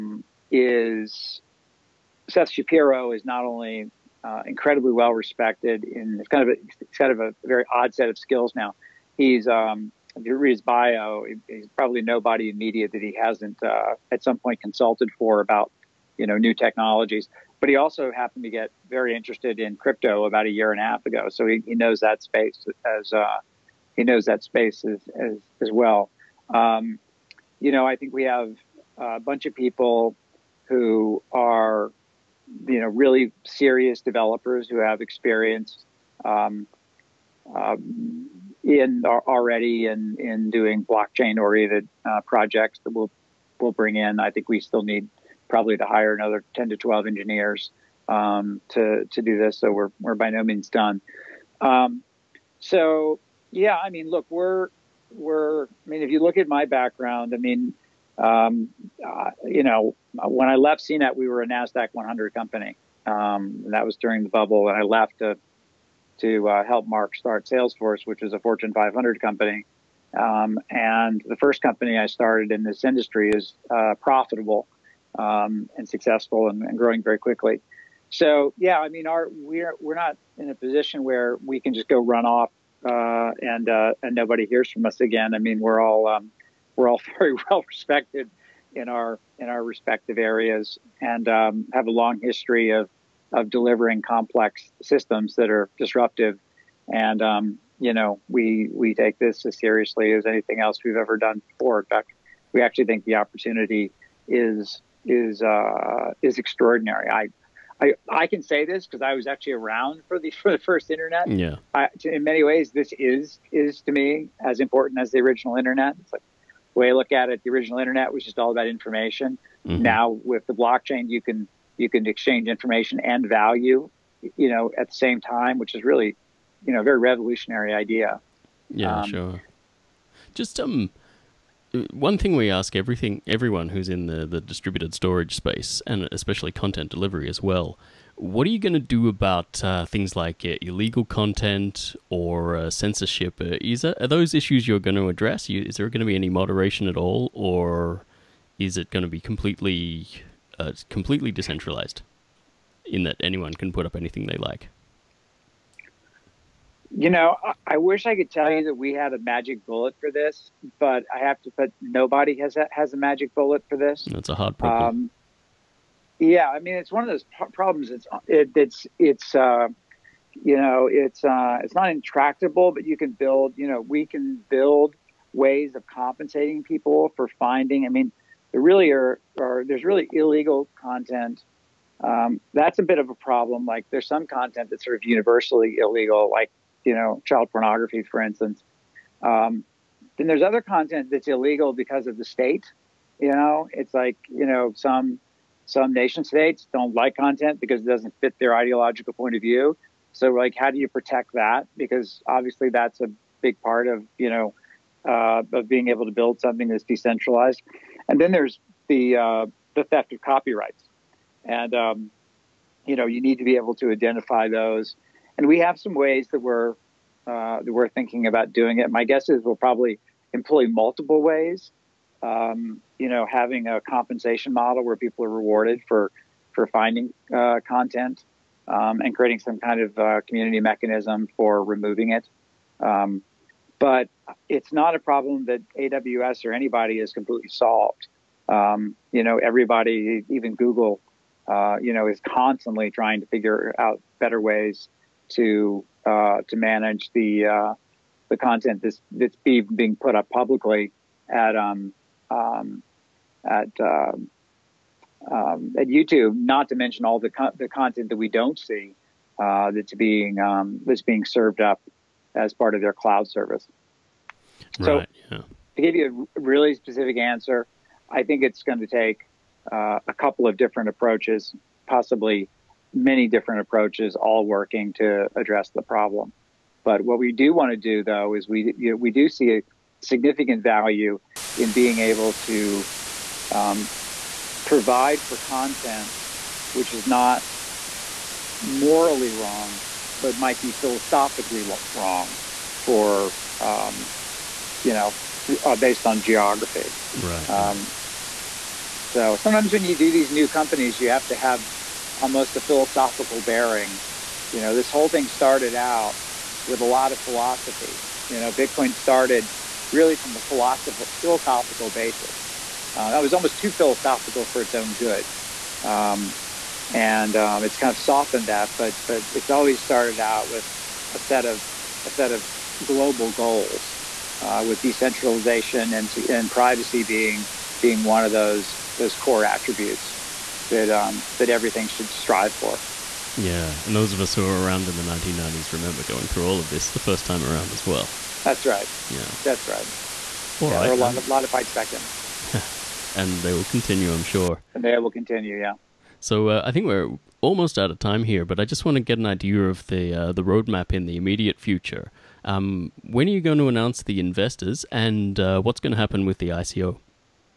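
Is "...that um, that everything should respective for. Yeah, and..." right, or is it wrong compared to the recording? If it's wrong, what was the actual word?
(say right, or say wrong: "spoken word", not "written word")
wrong: "strive", not "respective".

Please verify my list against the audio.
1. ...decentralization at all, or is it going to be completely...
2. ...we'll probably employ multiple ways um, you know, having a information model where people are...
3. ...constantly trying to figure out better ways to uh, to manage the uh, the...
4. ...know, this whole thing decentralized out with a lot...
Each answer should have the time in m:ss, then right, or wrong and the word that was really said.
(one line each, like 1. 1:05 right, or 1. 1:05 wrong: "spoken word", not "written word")
1. 2:26 wrong: "moderation", not "decentralization"
2. 3:39 wrong: "compensation", not "information"
3. 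4:02 right
4. 5:04 wrong: "started", not "decentralized".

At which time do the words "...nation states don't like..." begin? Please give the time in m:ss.
3:15.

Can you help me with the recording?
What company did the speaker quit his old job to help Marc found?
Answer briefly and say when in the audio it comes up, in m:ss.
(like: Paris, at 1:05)
Salesforce, at 1:07.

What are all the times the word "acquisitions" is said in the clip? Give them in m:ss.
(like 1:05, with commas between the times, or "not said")
not said.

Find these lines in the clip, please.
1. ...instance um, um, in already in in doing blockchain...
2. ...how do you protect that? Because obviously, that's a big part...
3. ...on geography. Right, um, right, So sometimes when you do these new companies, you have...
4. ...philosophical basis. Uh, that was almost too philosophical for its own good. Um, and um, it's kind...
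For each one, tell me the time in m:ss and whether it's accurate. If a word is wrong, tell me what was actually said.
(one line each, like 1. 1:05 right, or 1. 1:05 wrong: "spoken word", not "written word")
1. 0:35 wrong: "experience", not "instance"
2. 3:20 right
3. 4:56 right
4. 5:11 right.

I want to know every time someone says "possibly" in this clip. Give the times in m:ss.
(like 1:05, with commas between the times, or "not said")
4:31.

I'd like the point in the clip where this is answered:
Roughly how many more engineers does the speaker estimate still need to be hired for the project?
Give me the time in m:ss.
0:46.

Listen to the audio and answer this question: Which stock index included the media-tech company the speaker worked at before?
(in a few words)
Nasdaq 100.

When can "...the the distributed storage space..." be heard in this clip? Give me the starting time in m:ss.
2:14.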